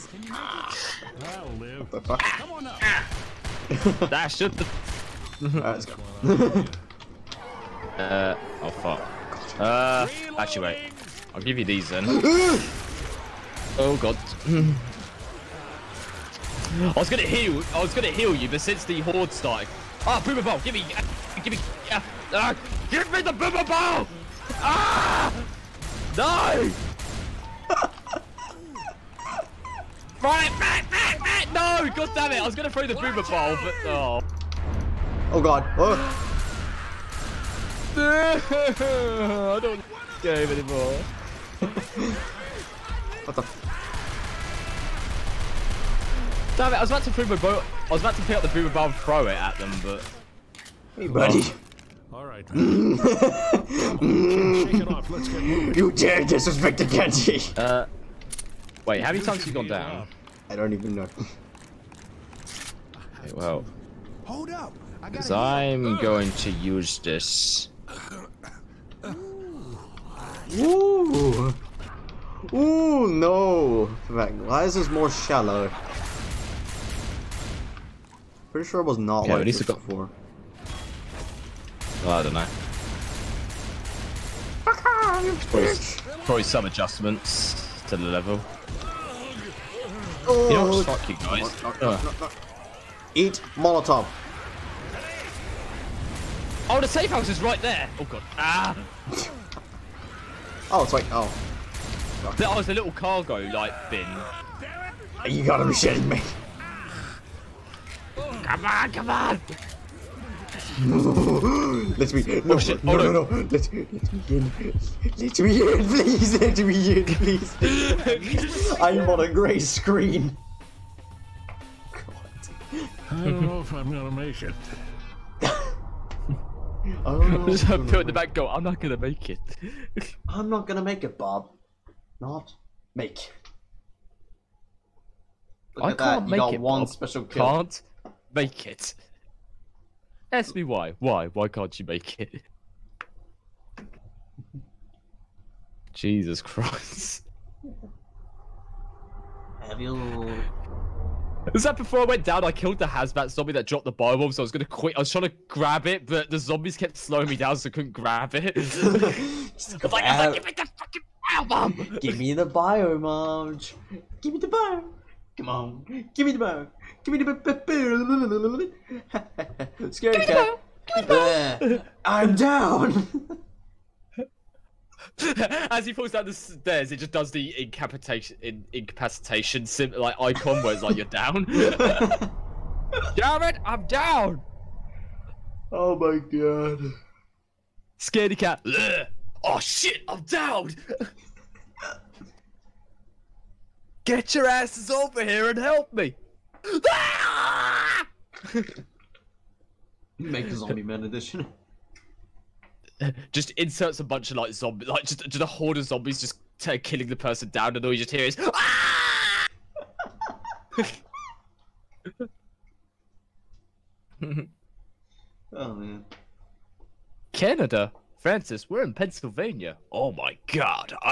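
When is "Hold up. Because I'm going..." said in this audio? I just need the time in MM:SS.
01:04.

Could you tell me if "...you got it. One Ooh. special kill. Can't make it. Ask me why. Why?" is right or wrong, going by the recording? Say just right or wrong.
wrong.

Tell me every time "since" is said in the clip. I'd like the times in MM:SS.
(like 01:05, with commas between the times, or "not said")
00:18.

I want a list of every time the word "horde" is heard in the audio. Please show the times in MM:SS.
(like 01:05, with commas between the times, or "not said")
00:19, 03:25.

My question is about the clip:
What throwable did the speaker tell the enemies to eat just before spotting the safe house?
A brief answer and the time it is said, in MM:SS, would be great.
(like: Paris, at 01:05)
Molotov, at 01:33.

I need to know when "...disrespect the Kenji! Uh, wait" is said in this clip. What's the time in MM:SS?
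00:56.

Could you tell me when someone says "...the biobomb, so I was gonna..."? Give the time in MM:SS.
02:33.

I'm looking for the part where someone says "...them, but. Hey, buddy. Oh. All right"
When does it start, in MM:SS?
00:49.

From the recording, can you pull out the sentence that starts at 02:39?
Like, like, give me the fucking biobomb!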